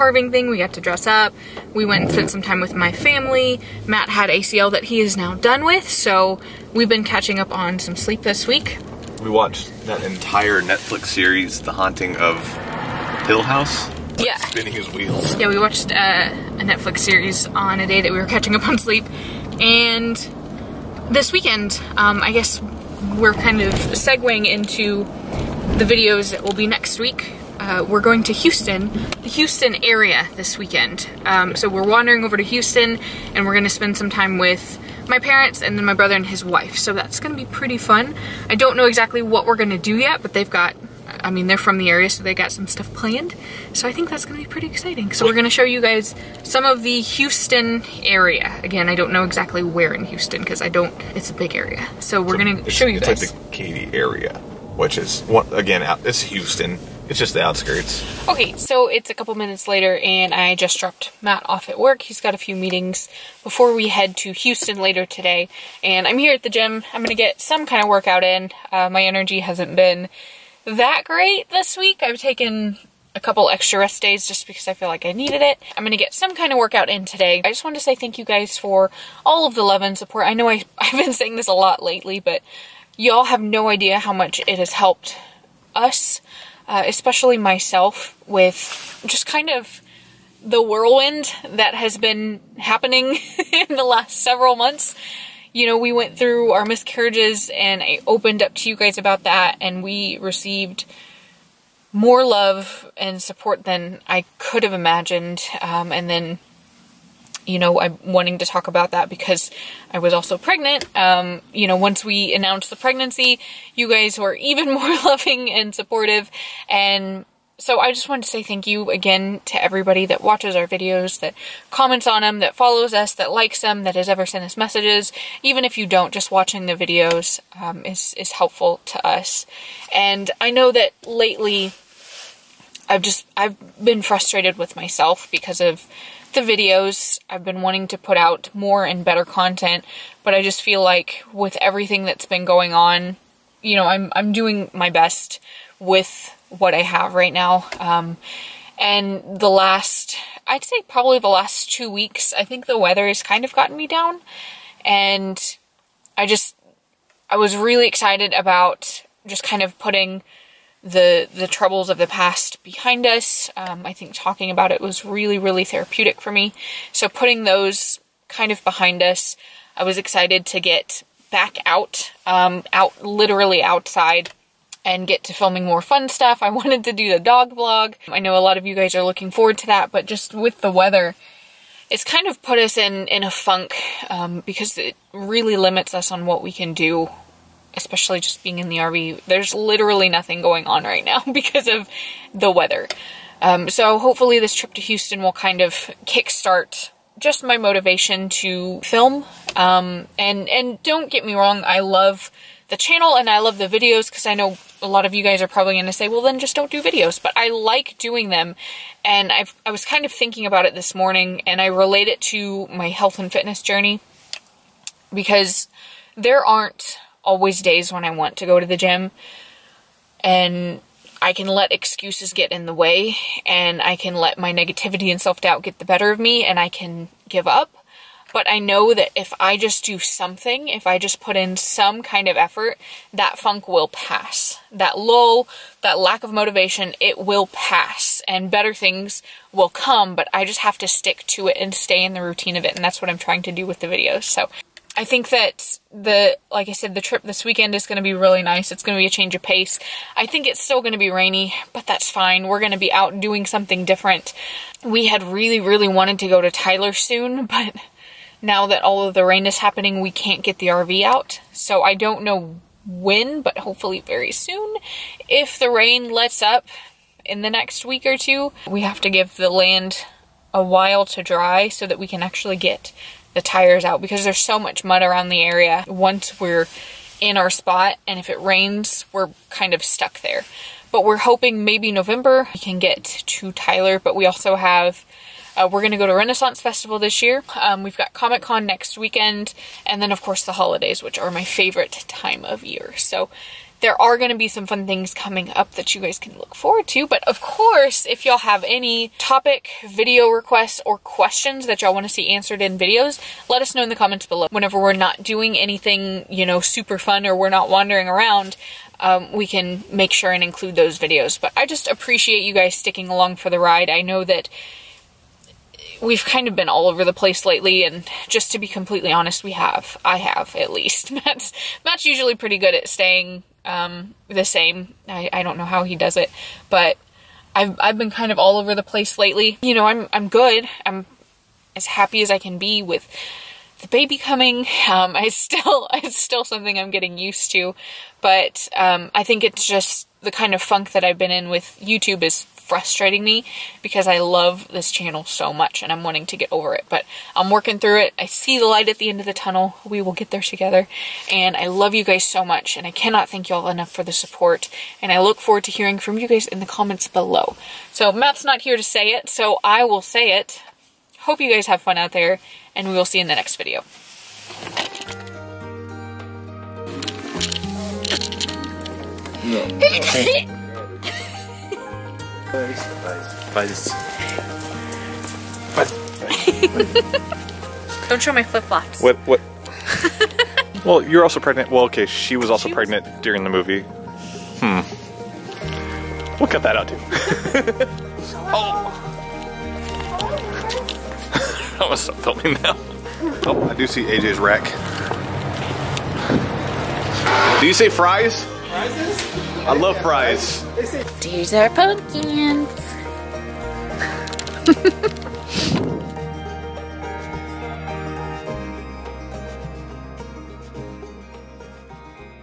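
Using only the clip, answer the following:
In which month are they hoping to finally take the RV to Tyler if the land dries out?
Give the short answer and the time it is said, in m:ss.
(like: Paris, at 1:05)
November, at 4:41.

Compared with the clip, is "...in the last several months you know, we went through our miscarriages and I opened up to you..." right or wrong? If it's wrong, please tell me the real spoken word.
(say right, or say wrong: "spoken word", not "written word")
right.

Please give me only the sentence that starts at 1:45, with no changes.
Um, and then, you know, I'm wanting to talk about that because I was also pregnant.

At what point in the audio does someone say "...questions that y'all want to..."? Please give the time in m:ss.
5:00.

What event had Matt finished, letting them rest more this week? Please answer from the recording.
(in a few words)
ACL.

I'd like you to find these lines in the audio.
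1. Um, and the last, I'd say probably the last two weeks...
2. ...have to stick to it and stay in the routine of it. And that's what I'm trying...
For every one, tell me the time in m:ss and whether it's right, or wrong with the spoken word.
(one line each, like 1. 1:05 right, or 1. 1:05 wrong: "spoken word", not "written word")
1. 2:27 right
2. 4:00 right.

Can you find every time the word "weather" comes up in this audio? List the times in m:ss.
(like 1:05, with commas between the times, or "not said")
2:32, 3:00, 3:12.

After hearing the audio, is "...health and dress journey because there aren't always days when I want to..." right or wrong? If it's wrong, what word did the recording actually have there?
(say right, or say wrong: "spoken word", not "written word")
wrong: "fitness", not "dress".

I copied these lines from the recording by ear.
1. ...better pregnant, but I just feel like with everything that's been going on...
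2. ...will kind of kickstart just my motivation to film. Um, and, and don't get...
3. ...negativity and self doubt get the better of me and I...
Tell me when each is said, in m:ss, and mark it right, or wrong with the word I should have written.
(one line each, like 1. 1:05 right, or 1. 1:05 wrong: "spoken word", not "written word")
1. 2:19 wrong: "content", not "pregnant"
2. 3:15 right
3. 3:44 right.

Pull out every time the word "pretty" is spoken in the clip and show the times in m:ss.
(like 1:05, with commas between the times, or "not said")
0:37, 0:44, 5:22.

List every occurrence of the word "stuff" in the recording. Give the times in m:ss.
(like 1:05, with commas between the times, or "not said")
0:42, 2:56.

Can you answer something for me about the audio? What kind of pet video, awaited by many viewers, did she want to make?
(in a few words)
dog vlog.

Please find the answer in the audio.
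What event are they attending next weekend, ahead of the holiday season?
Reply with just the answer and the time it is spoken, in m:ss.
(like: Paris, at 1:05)
Comic Con, at 4:48.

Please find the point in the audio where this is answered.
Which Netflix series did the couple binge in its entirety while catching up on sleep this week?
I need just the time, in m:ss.
0:11.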